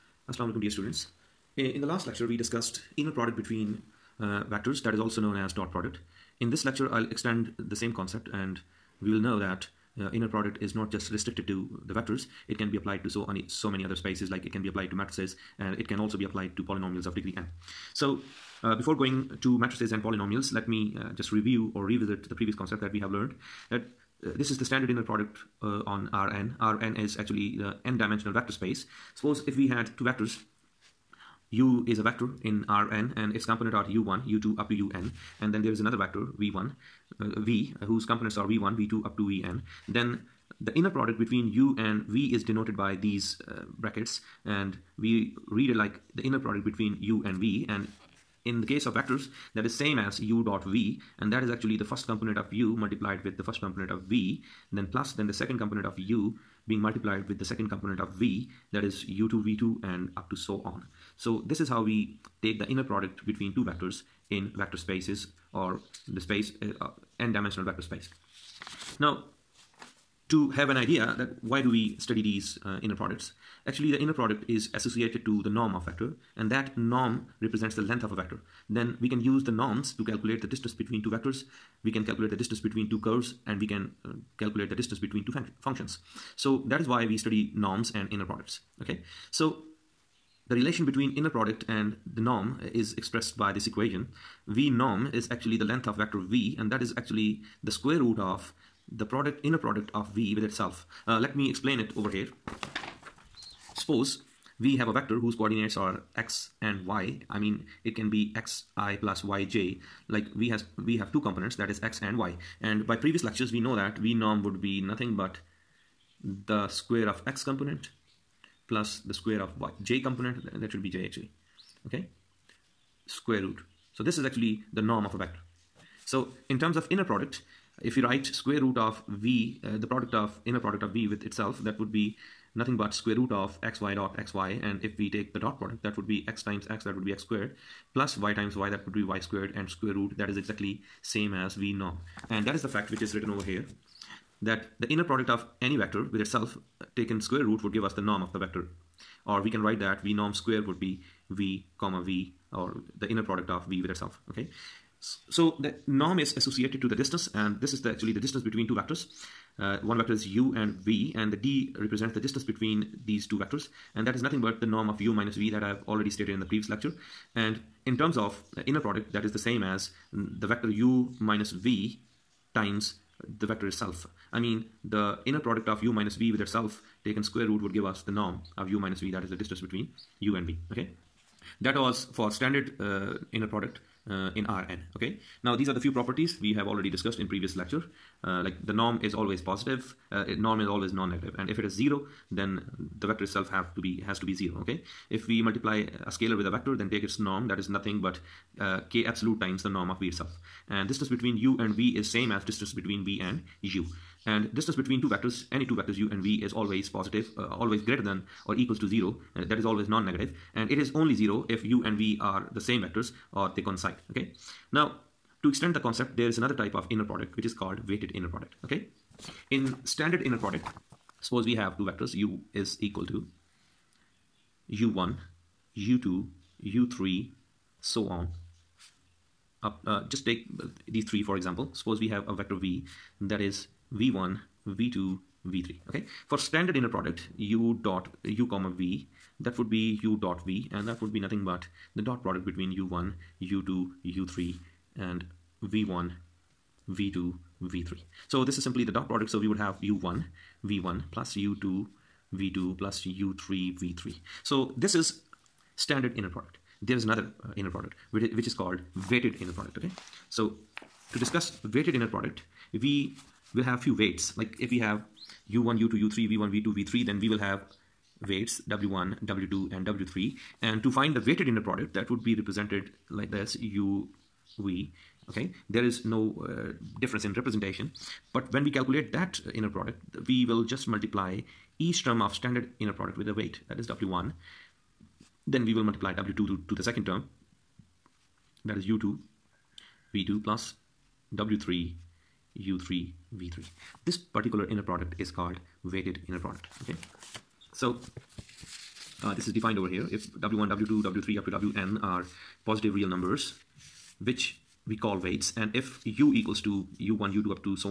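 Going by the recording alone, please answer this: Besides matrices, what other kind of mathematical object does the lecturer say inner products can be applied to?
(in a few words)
Polynomials of degree n.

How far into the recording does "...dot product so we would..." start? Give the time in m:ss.
4:08.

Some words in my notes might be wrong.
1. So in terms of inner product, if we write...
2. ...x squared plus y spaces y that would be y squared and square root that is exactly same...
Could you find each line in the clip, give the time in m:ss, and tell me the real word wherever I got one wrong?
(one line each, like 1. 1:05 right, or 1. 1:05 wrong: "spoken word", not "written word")
1. 2:06 right
2. 2:17 wrong: "times", not "spaces".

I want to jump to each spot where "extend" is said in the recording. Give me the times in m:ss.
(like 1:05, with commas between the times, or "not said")
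0:07, 3:35.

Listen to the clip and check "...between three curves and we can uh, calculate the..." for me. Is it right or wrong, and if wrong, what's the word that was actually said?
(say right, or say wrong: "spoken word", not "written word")
wrong: "two", not "three".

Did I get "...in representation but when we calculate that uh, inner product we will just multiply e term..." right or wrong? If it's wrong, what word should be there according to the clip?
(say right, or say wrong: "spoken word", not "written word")
right.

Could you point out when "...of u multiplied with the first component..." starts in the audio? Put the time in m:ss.
0:52.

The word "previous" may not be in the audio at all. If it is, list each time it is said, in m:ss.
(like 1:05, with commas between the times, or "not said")
0:22, 1:52, 2:46, 3:07.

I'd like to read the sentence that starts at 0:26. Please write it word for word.
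Rn is actually the n-dimensional vector space.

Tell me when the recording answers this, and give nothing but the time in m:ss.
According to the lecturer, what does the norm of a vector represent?
1:17.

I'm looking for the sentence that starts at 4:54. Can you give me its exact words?
This particular inner product is called weighted inner product.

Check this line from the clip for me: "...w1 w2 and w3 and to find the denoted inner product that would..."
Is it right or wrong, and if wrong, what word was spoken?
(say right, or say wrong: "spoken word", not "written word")
wrong: "weighted", not "denoted".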